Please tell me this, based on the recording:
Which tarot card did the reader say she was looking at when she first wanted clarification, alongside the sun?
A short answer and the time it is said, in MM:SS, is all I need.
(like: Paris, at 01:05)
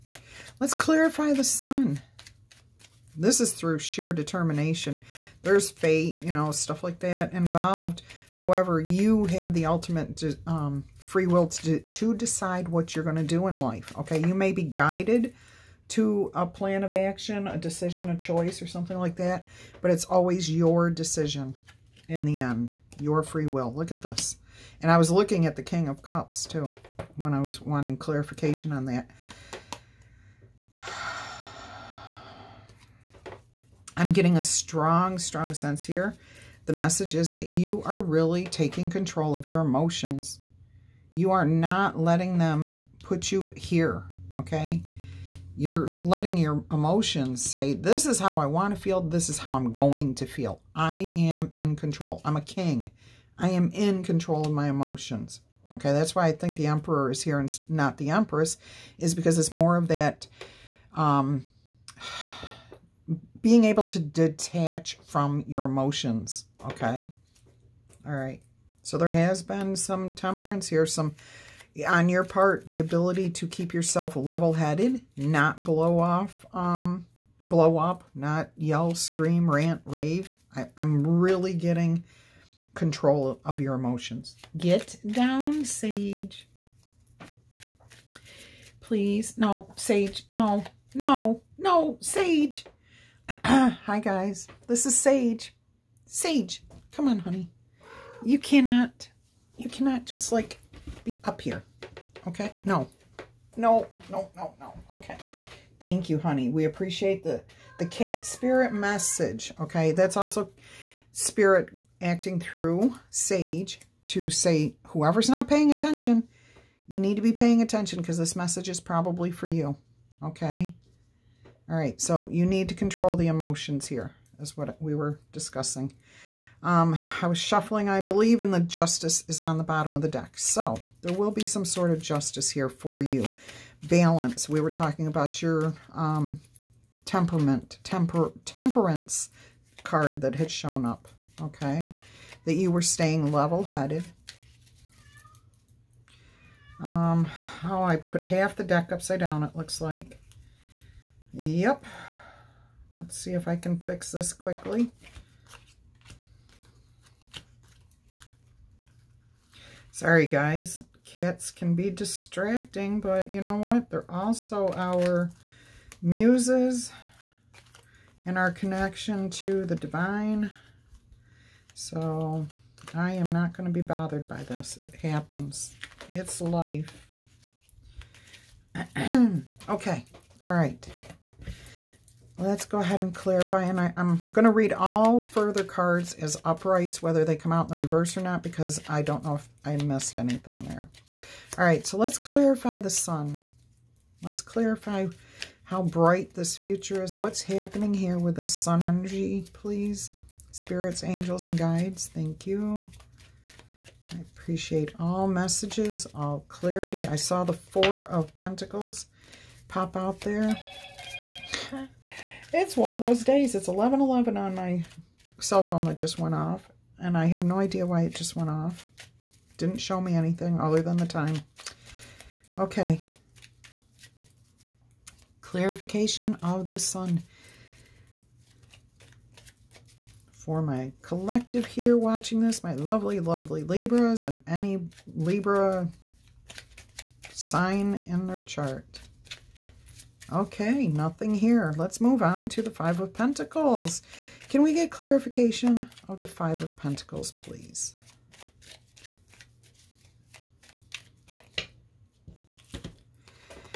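King of Cups, at 00:25.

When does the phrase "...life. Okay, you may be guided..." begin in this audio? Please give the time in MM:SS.
00:13.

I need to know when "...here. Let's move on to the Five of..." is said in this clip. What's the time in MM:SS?
04:01.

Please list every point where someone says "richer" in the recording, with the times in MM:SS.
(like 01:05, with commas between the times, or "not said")
not said.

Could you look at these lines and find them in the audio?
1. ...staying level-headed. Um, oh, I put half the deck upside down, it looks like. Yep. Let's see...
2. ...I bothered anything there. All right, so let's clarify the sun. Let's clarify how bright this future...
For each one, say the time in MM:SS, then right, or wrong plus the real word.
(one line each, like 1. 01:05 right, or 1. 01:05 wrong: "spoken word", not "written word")
1. 02:22 right
2. 03:09 wrong: "missed", not "bothered".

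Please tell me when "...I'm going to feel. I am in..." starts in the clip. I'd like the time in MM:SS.
00:49.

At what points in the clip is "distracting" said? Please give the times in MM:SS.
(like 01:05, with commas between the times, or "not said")
02:41.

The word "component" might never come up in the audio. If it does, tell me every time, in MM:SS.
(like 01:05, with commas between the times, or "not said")
not said.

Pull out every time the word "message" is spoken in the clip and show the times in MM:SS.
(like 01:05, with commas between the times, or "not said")
00:36, 01:48, 01:58, 03:25.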